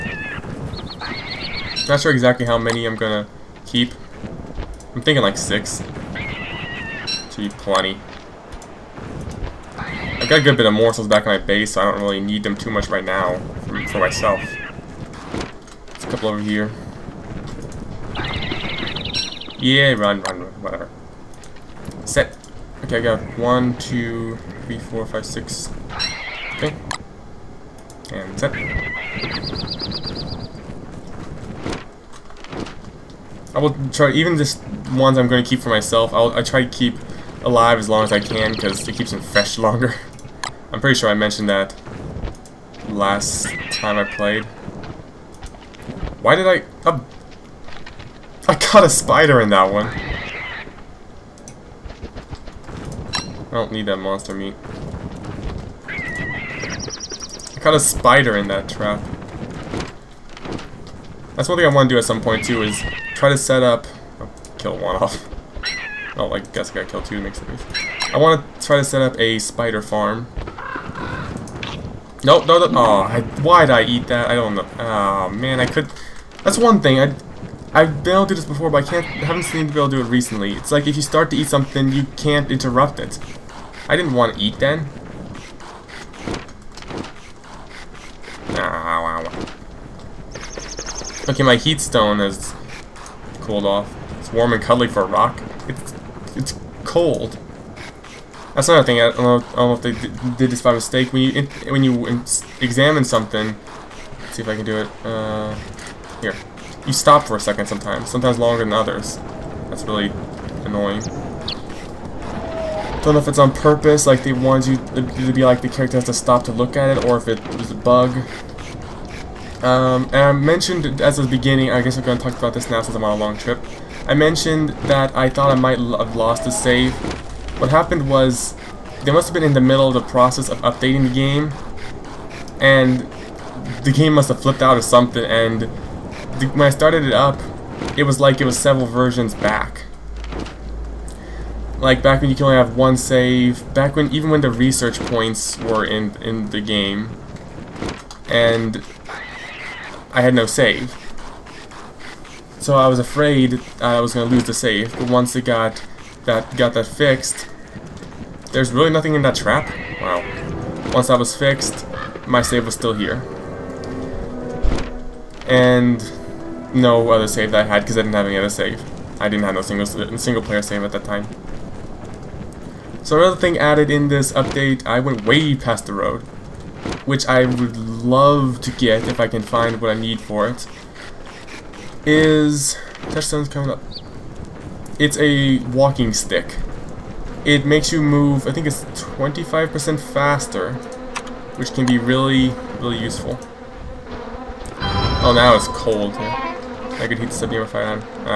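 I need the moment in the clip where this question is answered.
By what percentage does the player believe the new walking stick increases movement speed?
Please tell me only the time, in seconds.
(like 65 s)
188 s.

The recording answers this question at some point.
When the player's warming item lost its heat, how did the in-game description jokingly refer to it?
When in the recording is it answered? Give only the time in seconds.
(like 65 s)
94 s.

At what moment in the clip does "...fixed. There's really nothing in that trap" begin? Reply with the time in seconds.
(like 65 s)
156 s.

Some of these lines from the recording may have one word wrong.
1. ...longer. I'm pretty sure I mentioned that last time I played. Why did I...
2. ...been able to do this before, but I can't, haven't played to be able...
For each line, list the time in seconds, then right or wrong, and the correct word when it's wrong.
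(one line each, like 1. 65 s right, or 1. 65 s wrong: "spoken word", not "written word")
1. 39 s right
2. 78 s wrong: "seemed", not "played".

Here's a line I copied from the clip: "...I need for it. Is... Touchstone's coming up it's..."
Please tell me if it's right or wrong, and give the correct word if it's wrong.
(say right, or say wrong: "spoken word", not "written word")
right.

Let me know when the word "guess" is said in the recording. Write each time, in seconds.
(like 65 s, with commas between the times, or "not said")
66 s, 121 s.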